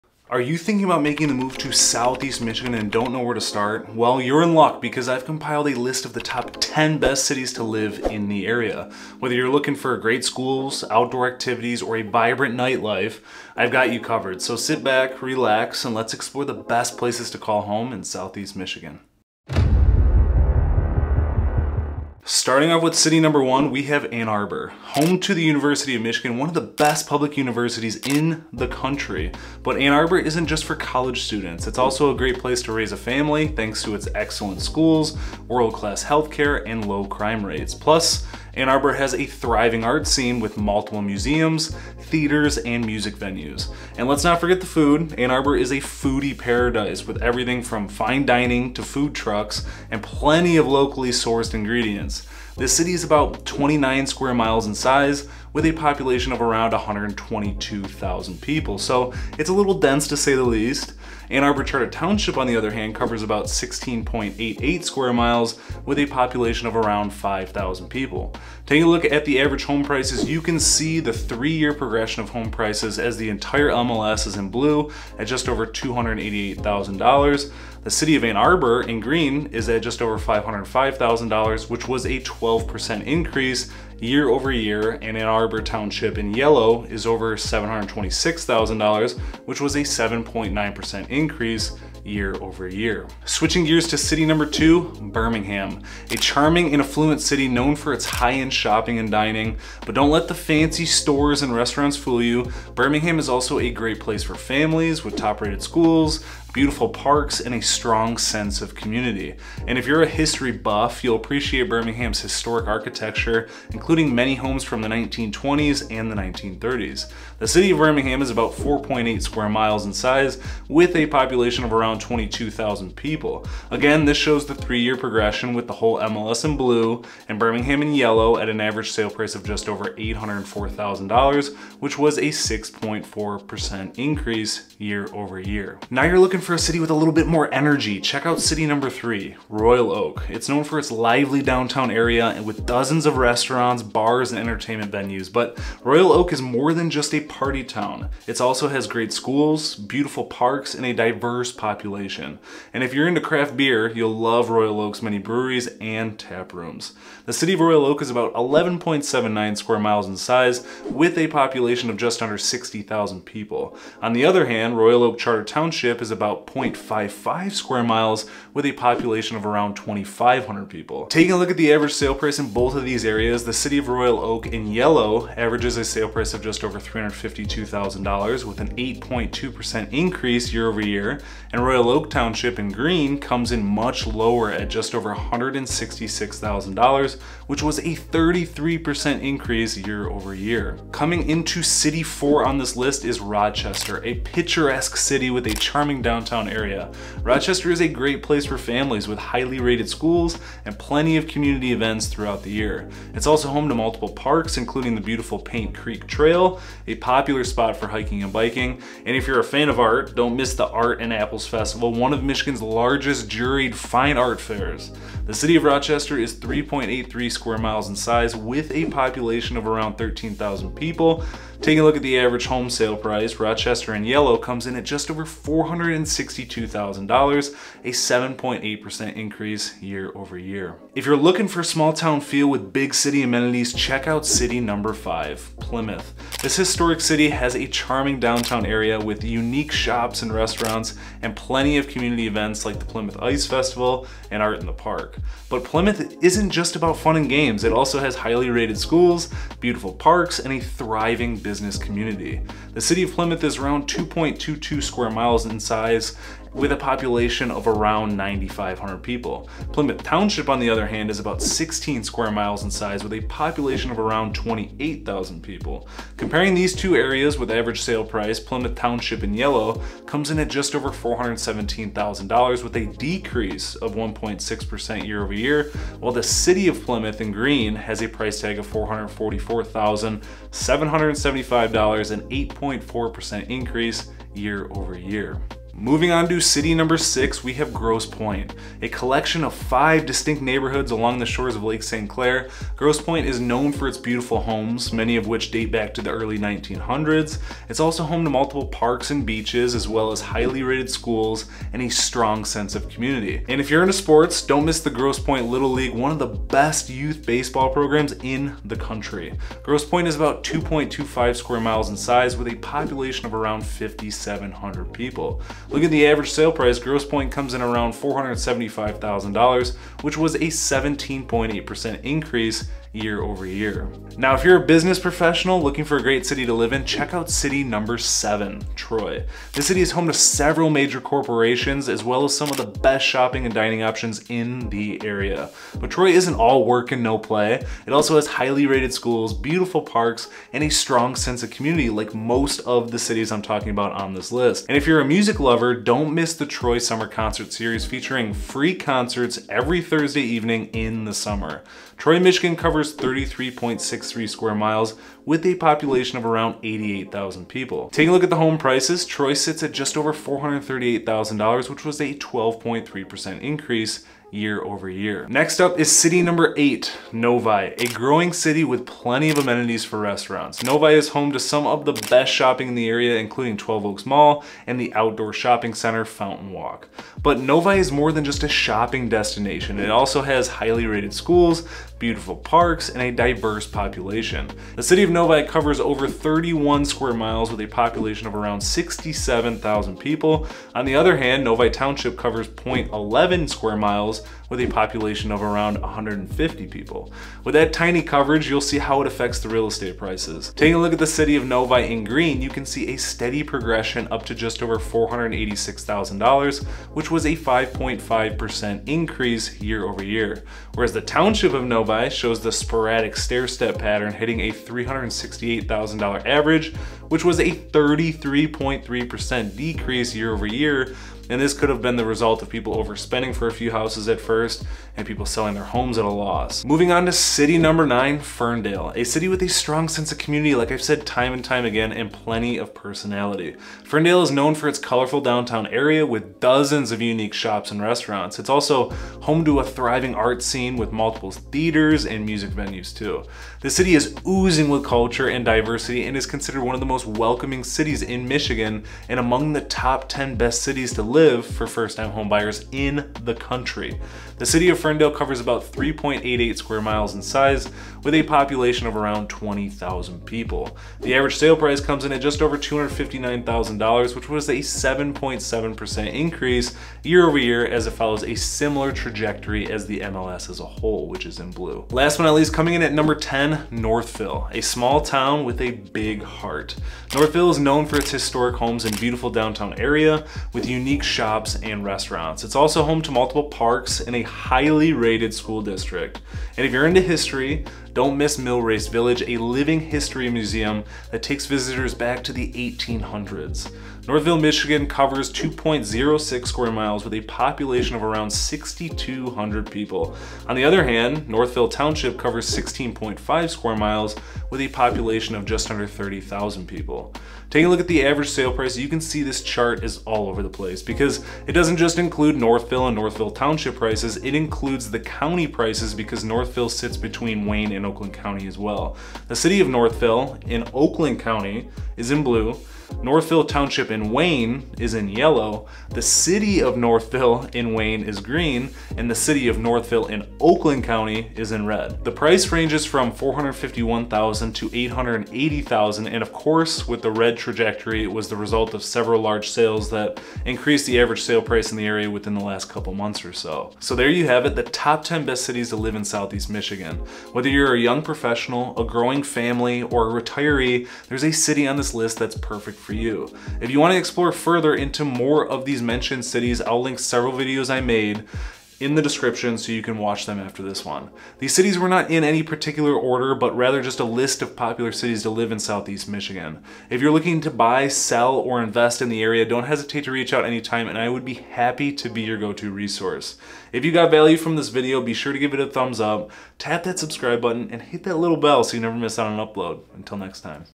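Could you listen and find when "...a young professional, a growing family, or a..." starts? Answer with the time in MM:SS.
09:07.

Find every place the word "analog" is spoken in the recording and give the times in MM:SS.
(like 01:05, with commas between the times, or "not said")
not said.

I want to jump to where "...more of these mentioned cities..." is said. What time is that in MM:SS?
09:15.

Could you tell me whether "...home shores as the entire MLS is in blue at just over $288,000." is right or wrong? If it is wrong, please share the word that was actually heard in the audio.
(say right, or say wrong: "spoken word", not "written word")
wrong: "prices", not "shores".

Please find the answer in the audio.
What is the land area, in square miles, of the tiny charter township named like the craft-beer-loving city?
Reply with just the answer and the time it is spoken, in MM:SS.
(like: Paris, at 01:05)
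0.55, at 02:46.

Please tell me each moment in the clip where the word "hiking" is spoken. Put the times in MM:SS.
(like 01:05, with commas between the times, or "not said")
03:27.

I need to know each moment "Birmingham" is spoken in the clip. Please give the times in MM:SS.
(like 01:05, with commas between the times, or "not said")
01:35, 01:42, 01:51, 01:57, 02:07.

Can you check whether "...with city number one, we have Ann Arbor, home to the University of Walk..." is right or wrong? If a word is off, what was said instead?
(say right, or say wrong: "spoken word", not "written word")
wrong: "Michigan", not "Walk".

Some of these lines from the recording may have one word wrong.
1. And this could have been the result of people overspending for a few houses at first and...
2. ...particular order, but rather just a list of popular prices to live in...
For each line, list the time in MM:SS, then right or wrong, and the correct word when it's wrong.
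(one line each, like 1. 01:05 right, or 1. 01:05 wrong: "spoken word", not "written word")
1. 07:01 right
2. 09:22 wrong: "cities", not "prices".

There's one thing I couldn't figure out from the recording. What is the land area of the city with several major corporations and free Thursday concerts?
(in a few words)
33.63 square miles.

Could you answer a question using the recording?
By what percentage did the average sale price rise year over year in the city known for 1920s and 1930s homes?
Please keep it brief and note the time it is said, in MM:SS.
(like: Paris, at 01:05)
6.4%, at 02:12.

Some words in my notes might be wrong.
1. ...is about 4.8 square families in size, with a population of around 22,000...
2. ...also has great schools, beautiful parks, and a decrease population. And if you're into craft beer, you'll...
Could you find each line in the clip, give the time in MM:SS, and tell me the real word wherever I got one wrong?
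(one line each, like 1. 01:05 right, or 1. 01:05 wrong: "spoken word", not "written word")
1. 01:58 wrong: "miles", not "families"
2. 02:28 wrong: "diverse", not "decrease".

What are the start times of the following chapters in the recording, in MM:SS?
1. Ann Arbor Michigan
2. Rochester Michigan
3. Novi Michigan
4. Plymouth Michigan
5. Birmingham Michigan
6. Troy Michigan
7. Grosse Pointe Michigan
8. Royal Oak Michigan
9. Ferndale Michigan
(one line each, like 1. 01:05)
1. 00:22
2. 03:10
3. 06:05
4. 03:50
5. 01:33
6. 05:24
7. 04:45
8. 02:15
9. 07:06.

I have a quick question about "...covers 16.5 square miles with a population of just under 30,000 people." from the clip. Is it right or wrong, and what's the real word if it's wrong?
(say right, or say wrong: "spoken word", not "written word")
right.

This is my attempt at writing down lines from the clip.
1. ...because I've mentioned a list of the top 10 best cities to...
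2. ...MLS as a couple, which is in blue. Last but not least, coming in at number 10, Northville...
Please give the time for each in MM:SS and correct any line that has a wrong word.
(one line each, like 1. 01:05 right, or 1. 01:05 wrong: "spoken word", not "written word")
1. 00:04 wrong: "compiled", not "mentioned"
2. 07:49 wrong: "whole", not "couple".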